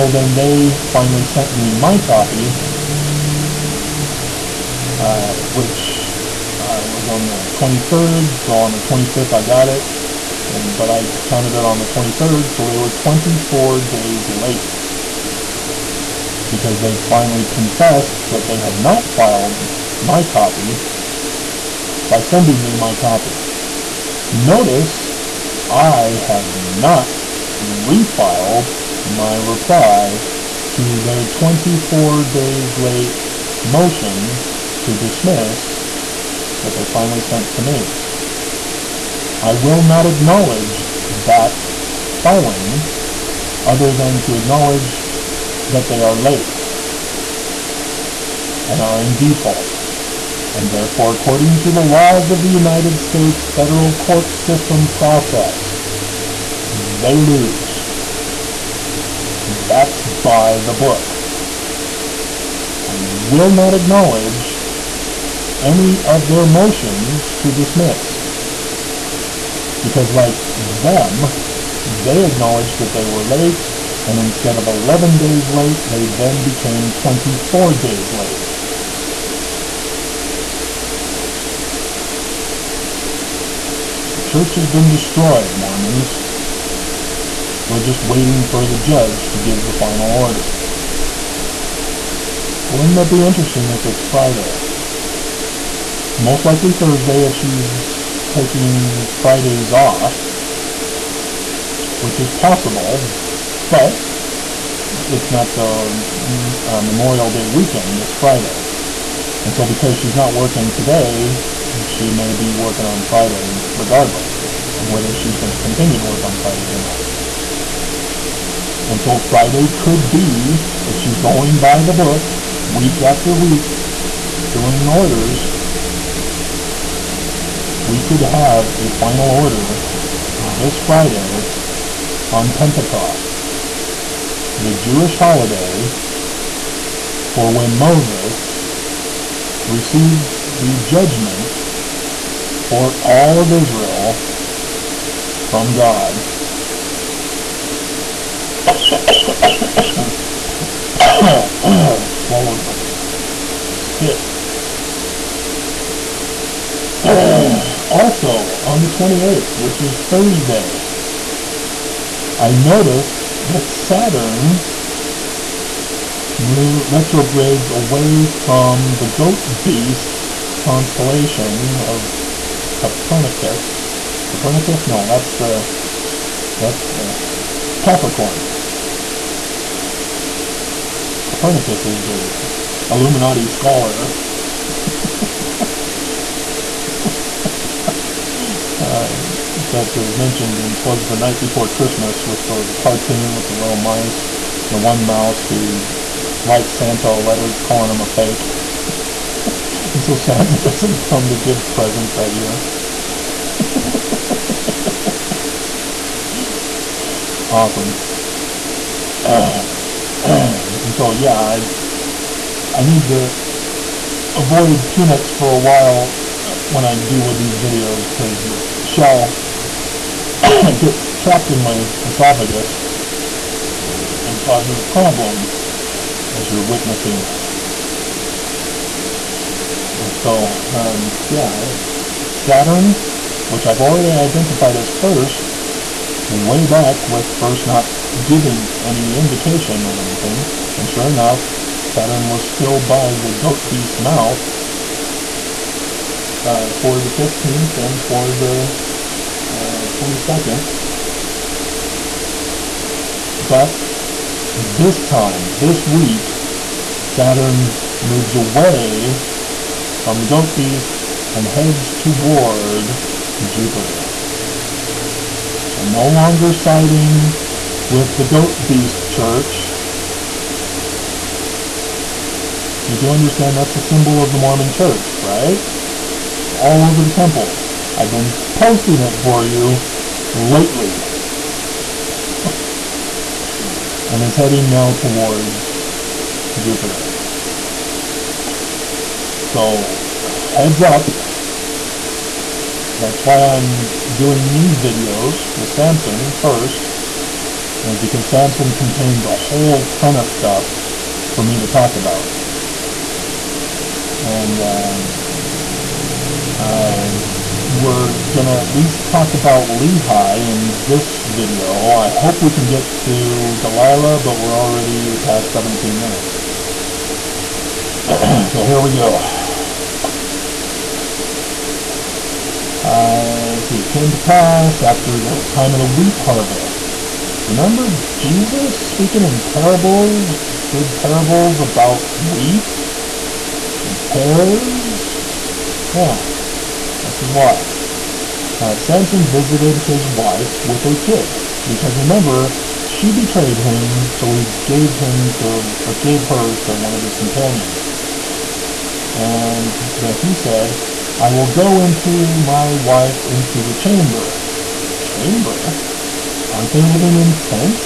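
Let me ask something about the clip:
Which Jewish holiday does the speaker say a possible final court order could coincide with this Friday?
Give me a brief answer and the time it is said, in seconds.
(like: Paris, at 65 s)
Pentecost, at 132 s.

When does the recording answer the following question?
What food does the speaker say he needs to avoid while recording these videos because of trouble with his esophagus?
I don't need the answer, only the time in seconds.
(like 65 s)
214 s.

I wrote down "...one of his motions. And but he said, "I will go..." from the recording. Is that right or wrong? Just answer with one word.
wrong.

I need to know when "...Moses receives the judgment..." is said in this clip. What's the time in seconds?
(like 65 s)
137 s.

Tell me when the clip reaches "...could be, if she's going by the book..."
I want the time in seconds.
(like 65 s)
119 s.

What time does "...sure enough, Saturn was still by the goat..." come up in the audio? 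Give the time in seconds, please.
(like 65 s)
240 s.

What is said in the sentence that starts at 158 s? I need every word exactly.
on the 28th, which is Thursday, I noticed that Saturn retrogrades away from the goat beast constellation of Copernicus.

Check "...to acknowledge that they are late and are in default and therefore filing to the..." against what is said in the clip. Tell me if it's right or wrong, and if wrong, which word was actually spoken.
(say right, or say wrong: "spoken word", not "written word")
wrong: "according", not "filing".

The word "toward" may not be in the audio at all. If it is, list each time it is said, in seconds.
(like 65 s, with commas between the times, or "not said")
262 s, 284 s.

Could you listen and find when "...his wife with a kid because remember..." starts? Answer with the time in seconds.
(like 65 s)
339 s.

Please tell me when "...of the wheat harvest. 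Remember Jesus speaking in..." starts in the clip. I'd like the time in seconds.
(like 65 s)
325 s.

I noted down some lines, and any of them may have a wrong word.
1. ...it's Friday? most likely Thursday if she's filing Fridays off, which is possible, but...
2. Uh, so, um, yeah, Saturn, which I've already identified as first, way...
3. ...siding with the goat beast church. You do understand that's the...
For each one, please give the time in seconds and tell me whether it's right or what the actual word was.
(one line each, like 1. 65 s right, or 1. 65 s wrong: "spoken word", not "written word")
1. 93 s wrong: "taking", not "filing"
2. 229 s right
3. 266 s right.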